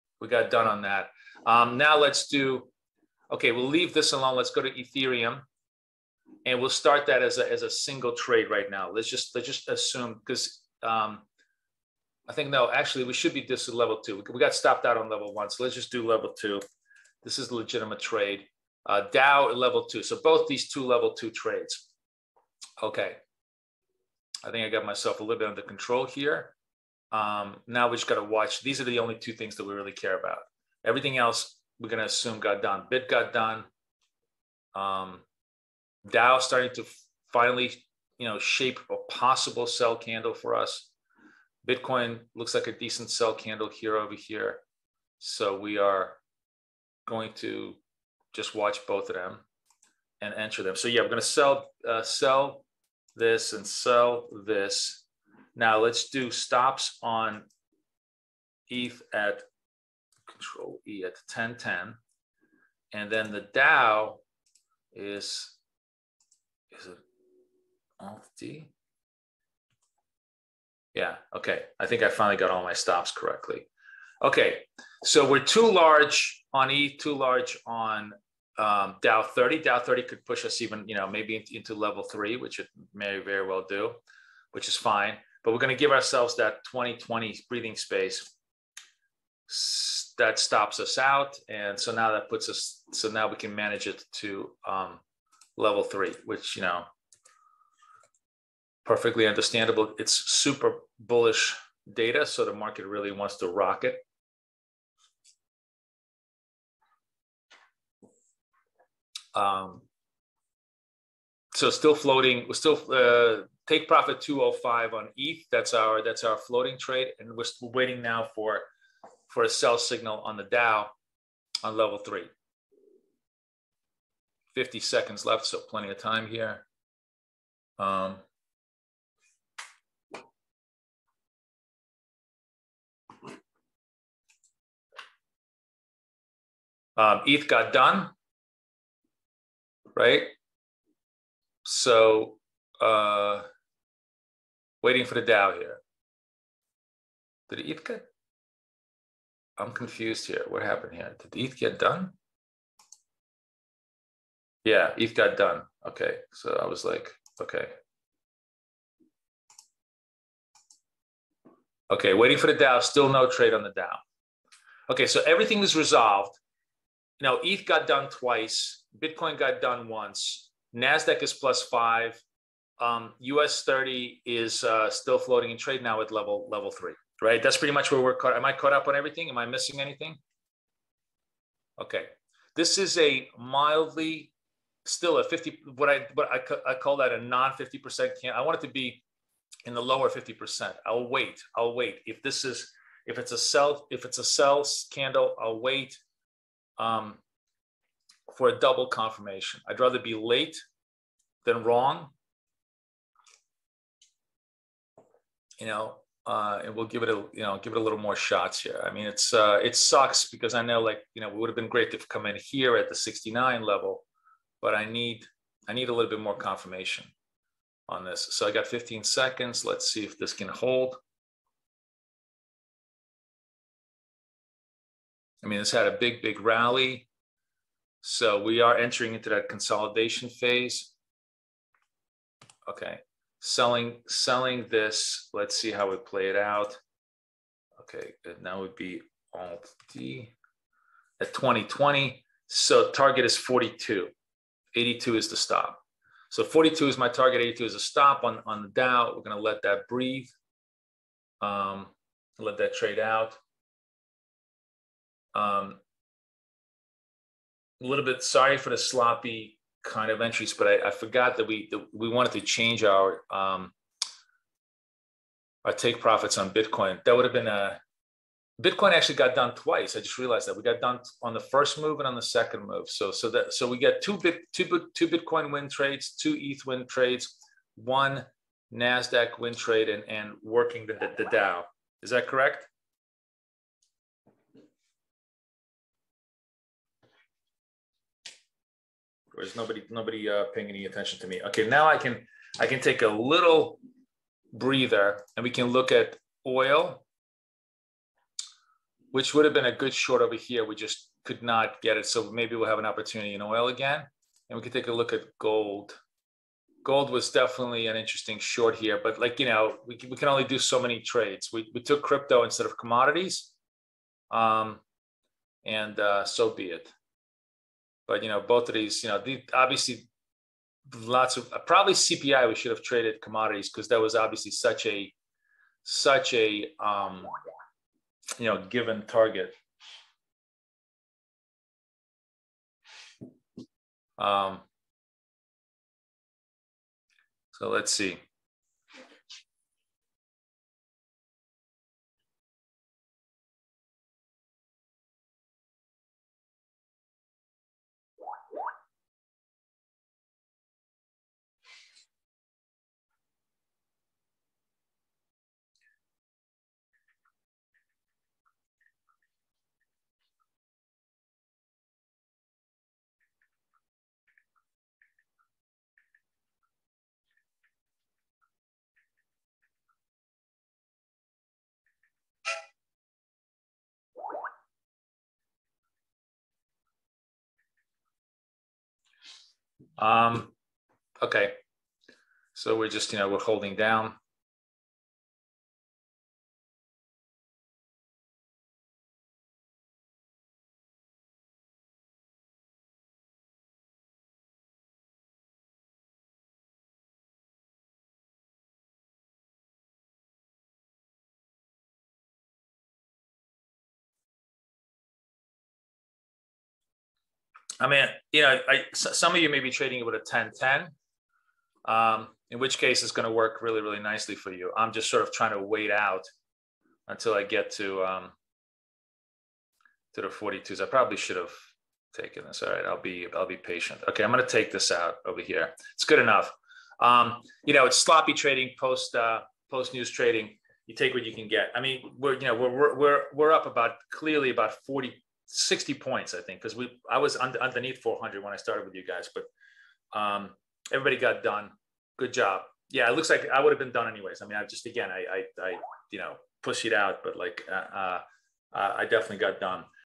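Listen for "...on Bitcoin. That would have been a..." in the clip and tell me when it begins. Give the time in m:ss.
4:26.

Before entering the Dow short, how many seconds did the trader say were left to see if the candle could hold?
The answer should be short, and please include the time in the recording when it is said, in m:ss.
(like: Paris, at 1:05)
15, at 3:38.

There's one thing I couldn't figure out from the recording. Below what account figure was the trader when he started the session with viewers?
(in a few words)
400.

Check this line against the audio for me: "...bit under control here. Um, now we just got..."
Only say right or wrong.
right.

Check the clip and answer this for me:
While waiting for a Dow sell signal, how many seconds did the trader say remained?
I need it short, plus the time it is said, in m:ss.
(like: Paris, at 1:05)
50, at 2:04.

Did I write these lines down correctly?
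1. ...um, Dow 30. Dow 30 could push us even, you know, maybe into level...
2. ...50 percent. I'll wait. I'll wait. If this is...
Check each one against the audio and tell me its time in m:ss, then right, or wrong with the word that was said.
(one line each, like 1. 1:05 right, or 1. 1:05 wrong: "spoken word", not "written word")
1. 1:18 right
2. 3:10 right.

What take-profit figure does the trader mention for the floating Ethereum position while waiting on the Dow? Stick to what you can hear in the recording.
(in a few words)
205.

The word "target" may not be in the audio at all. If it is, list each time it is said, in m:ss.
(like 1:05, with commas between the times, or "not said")
4:02, 4:07, 5:29.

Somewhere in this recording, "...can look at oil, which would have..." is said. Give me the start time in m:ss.
4:55.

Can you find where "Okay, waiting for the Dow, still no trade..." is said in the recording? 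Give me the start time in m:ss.
2:41.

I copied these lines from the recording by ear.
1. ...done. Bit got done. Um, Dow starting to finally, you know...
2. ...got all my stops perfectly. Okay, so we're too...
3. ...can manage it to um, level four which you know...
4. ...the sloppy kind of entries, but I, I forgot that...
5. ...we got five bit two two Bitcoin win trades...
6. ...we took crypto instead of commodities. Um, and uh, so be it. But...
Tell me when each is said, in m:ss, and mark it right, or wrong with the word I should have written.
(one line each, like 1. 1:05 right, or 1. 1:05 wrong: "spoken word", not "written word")
1. 0:32 right
2. 1:12 wrong: "correctly", not "perfectly"
3. 1:33 wrong: "three", not "four"
4. 4:18 right
5. 4:33 wrong: "two", not "five"
6. 5:11 right.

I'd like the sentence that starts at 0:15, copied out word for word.
So let's just do level two.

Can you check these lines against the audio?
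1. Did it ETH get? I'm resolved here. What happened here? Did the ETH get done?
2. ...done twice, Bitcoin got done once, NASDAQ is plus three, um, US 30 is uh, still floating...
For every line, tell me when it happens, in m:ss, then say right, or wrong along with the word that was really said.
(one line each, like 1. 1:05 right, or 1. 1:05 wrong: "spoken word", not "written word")
1. 2:27 wrong: "confused", not "resolved"
2. 2:47 wrong: "five", not "three".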